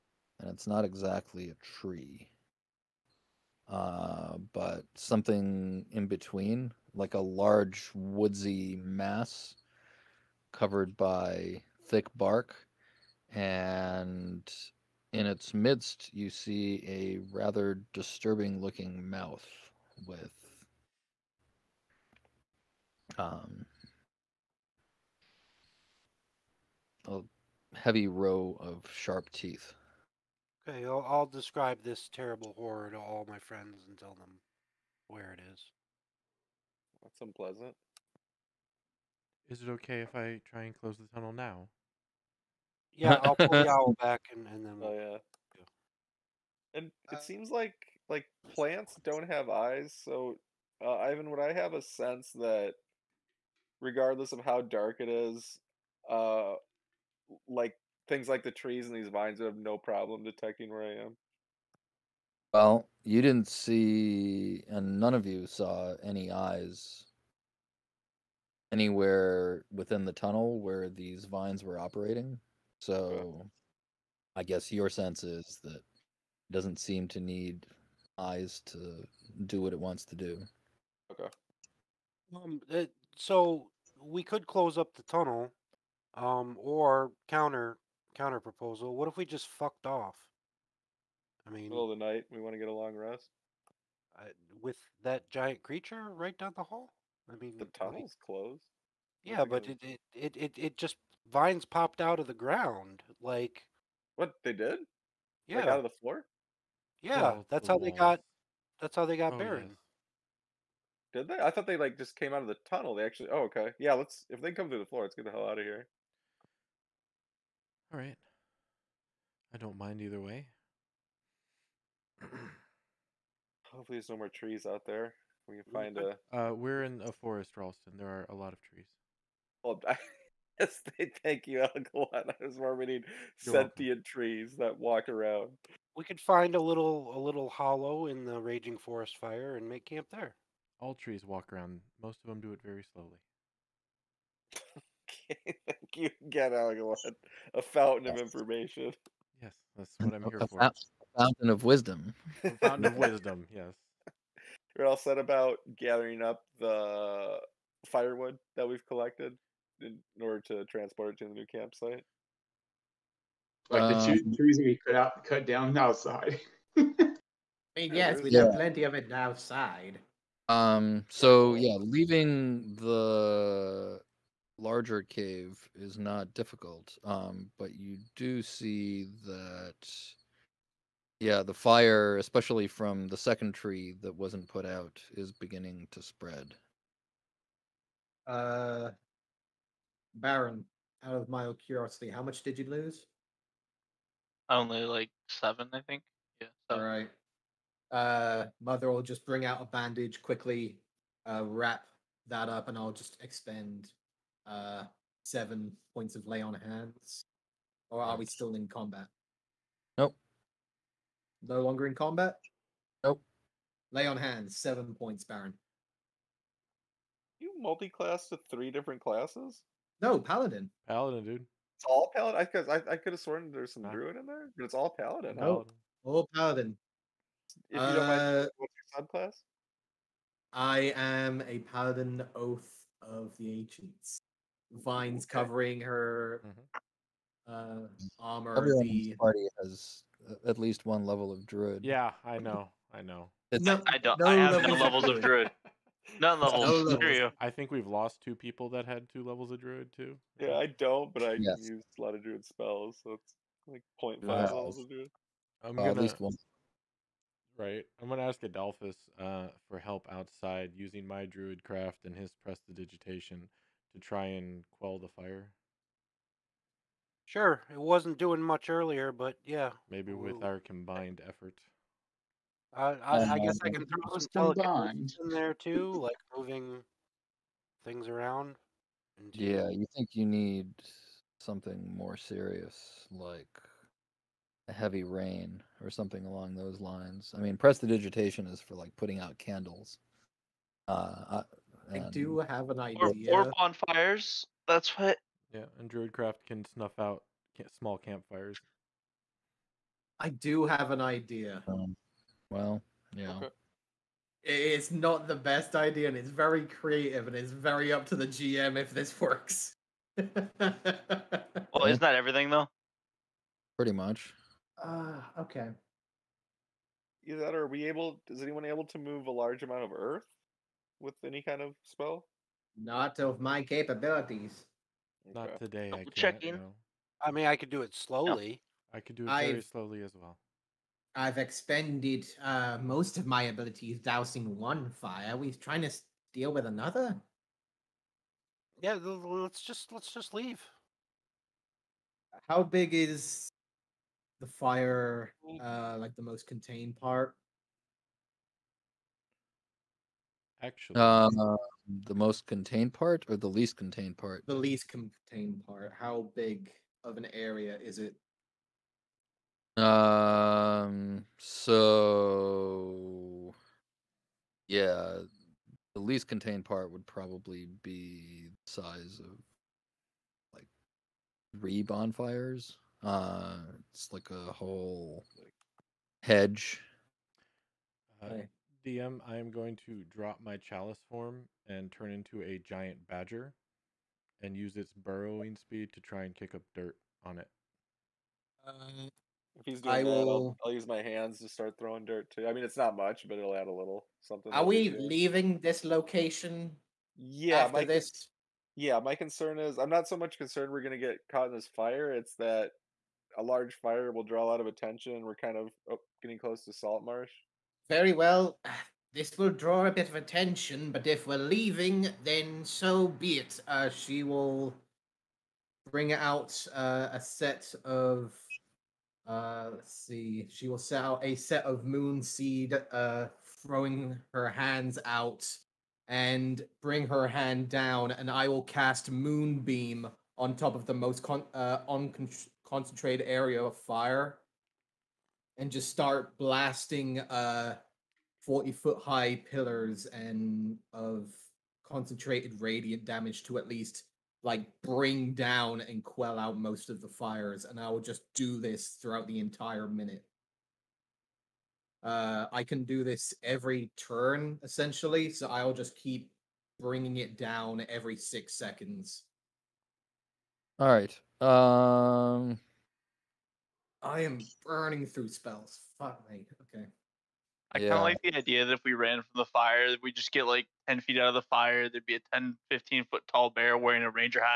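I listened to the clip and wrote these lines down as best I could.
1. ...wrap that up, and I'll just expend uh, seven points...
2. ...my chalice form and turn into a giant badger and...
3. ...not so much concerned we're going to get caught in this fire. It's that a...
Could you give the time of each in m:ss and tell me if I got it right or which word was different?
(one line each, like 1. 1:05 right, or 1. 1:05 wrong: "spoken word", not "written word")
1. 3:21 right
2. 6:20 right
3. 6:39 right.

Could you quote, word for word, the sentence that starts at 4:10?
Yeah, I don't, but I yes.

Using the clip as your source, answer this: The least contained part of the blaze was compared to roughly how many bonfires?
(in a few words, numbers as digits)
3.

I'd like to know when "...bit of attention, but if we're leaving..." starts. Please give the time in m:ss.
6:49.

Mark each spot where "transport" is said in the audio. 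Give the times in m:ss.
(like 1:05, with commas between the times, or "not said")
2:40.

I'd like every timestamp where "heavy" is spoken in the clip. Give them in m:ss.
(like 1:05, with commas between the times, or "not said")
0:27, 4:44.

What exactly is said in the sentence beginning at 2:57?
Um, but you do see that, yeah, the fire, especially from the second tree that wasn't put out, is beginning to spread.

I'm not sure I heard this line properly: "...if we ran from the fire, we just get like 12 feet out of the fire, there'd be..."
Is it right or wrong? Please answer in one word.
wrong.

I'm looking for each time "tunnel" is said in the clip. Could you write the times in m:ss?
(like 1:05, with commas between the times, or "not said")
0:41, 1:10, 1:25, 1:37, 1:52.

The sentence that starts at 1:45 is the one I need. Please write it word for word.
Yeah, like out of the floor.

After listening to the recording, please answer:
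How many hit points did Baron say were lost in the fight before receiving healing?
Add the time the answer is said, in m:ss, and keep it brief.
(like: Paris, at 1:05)
7, at 3:14.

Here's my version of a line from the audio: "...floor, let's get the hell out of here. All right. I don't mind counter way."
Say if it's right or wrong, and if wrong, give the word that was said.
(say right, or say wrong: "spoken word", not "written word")
wrong: "either", not "counter".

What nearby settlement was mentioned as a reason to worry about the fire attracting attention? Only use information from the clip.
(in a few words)
Salt Marsh.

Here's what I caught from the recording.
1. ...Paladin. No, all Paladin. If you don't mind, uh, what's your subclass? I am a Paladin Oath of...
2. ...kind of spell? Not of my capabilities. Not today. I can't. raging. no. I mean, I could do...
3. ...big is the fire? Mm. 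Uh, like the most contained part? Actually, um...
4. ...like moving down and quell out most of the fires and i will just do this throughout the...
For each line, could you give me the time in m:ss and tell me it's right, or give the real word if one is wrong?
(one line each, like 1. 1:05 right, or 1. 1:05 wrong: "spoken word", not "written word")
1. 3:44 right
2. 5:21 wrong: "checking", not "raging"
3. 5:42 right
4. 7:24 wrong: "bring", not "moving".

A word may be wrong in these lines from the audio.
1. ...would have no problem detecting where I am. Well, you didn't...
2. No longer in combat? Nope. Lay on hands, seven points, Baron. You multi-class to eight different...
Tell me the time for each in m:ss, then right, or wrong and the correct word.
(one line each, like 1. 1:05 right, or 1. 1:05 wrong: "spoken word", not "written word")
1. 0:59 right
2. 3:31 wrong: "three", not "eight".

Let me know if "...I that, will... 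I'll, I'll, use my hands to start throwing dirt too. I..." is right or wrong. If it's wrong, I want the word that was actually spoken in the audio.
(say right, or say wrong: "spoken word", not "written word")
right.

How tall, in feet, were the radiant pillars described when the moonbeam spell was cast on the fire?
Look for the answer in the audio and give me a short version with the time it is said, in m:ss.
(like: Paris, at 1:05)
40, at 7:18.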